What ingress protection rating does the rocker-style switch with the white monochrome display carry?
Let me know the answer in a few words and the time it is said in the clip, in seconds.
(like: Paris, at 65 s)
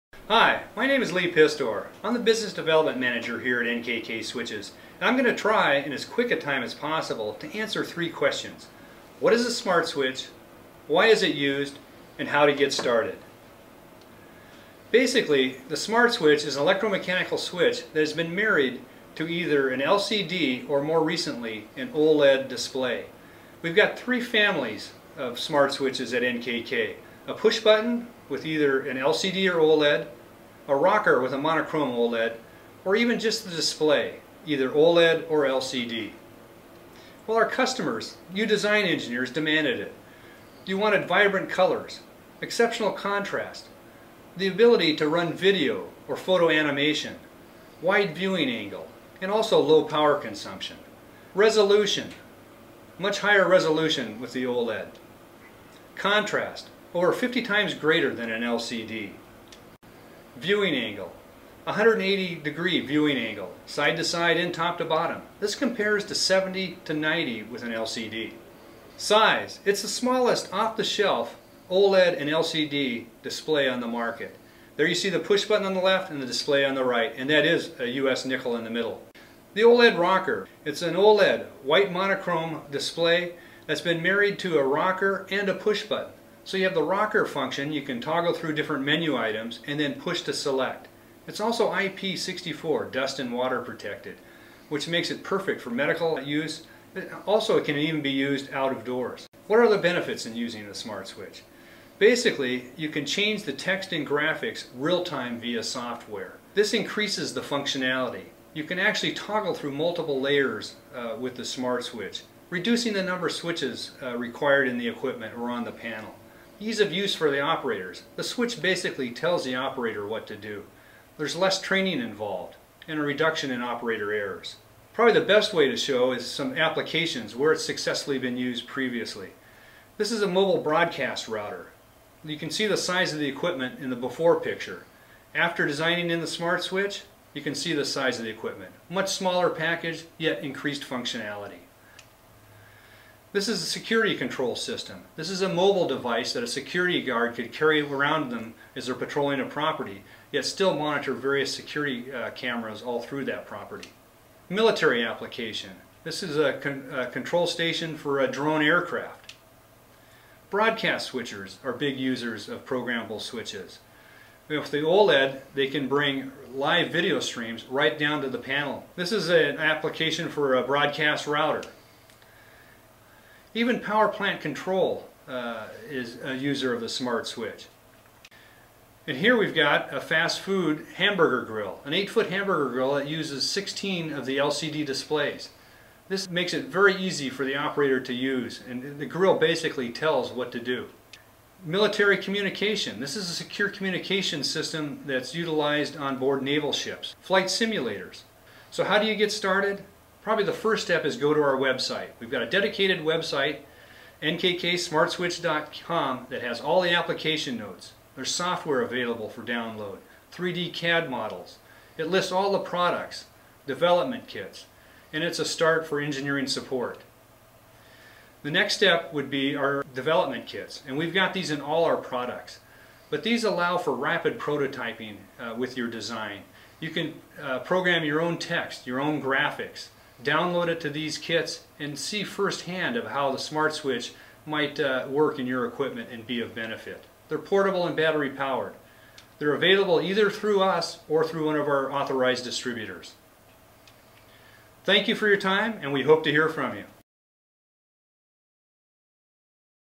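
IP64, at 91 s.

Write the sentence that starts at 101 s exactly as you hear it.
Basically, you can change the text and graphics real-time via software.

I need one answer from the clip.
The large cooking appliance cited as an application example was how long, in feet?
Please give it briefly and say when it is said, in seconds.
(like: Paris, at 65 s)
8 feet, at 181 s.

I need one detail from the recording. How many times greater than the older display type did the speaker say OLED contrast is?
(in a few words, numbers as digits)
50 times.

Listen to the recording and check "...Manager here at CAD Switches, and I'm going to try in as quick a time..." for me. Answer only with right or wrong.
wrong.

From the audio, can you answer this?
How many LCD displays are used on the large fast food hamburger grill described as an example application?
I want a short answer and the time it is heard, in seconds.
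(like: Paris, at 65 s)
16, at 183 s.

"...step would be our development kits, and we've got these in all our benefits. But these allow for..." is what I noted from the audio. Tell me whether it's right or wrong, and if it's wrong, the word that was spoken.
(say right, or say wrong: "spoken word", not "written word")
wrong: "products", not "benefits".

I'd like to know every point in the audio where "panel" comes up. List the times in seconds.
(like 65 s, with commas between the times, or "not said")
115 s, 168 s.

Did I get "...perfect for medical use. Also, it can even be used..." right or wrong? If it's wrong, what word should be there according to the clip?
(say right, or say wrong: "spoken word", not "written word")
right.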